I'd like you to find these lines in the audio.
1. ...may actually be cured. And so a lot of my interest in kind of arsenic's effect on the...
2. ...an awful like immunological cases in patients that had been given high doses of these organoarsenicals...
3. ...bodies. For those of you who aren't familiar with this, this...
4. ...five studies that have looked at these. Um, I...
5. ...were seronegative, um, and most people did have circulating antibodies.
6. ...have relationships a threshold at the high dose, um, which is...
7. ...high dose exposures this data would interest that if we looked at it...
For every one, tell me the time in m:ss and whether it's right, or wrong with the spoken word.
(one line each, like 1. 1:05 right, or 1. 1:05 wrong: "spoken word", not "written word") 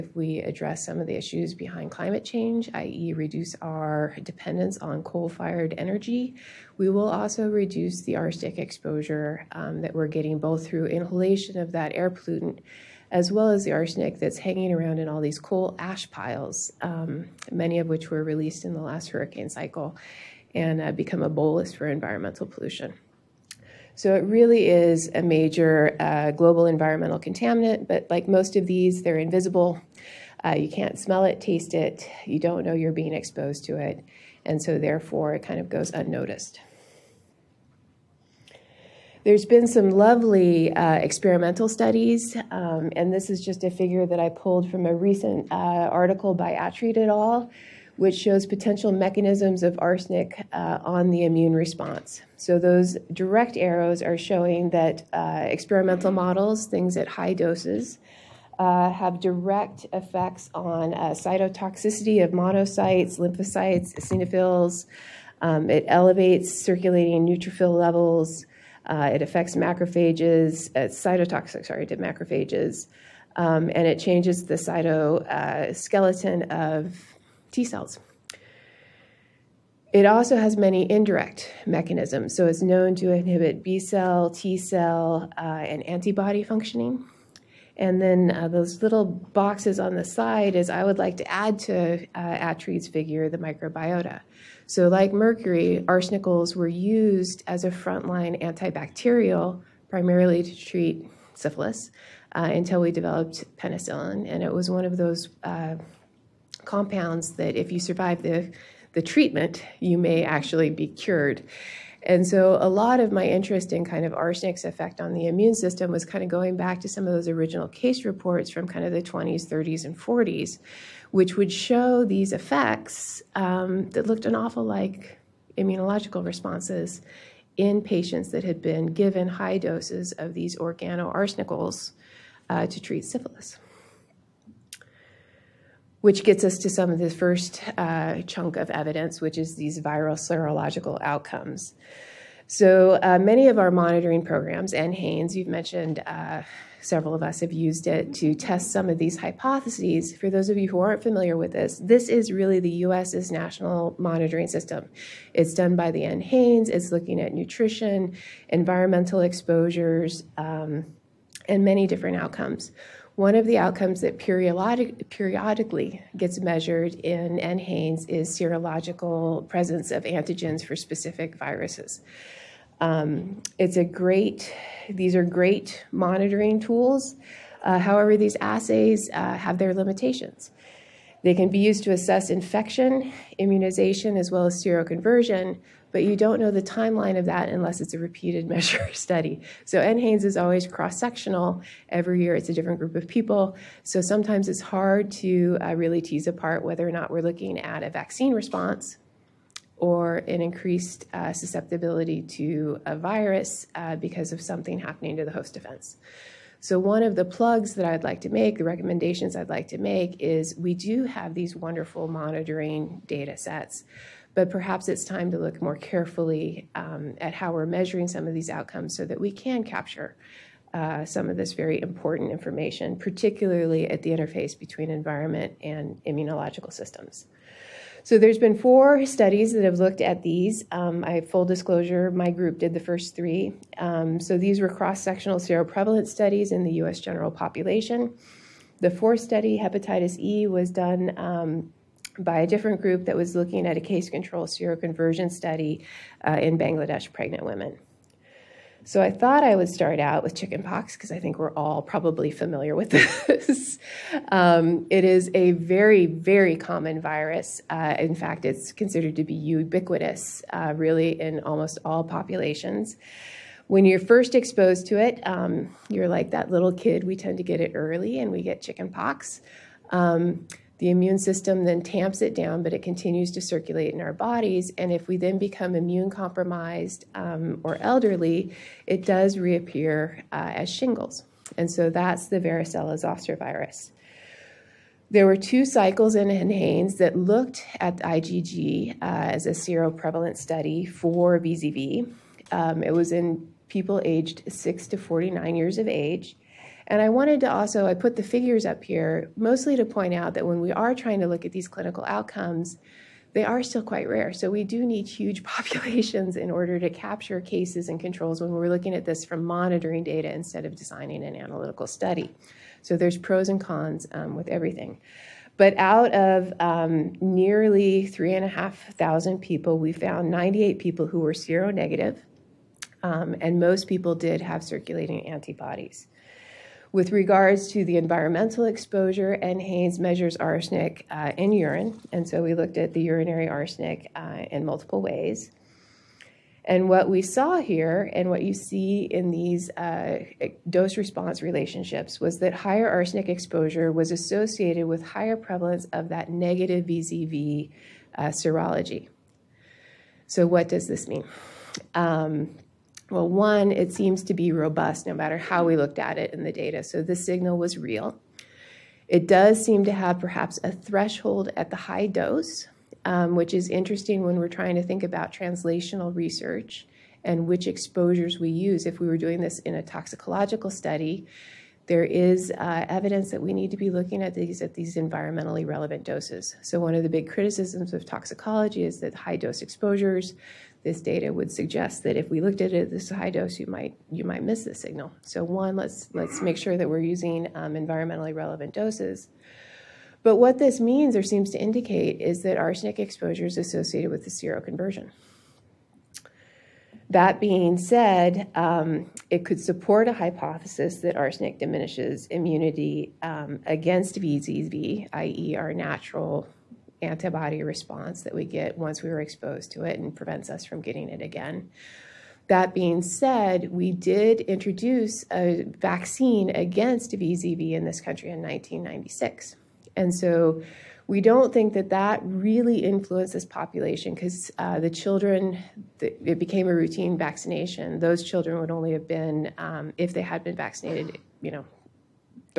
1. 1:49 right
2. 2:04 wrong: "responses", not "cases"
3. 2:29 wrong: "hypotheses", not "bodies"
4. 3:48 wrong: "four", not "five"
5. 5:21 right
6. 5:59 wrong: "perhaps", not "relationships"
7. 6:19 wrong: "suggest", not "interest".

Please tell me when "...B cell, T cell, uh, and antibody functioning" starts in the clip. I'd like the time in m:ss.
1:23.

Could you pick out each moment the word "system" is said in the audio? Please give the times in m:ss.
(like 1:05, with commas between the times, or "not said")
1:55, 2:34, 3:46, 4:31.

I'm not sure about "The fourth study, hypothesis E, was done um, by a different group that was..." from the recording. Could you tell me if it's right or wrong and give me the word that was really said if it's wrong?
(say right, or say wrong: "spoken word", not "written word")
wrong: "hepatitis", not "hypothesis".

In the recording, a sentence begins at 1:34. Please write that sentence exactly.
So, like mercury, arsenicals were used as a frontline antibacterial primarily to treat syphilis uh, until we developed penicillin.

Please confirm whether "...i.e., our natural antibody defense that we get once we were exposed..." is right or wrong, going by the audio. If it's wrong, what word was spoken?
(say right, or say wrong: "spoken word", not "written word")
wrong: "response", not "defense".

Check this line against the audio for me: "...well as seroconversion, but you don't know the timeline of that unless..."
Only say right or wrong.
right.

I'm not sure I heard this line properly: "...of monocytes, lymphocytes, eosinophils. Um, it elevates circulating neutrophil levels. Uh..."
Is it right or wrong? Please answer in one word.
right.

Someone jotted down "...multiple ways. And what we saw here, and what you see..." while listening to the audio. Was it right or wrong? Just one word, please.
right.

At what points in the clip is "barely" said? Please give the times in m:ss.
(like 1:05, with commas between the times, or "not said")
not said.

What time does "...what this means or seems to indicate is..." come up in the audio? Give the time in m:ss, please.
6:30.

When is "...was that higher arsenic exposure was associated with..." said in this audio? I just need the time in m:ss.
5:42.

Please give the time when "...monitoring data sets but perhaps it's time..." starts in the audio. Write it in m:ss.
3:32.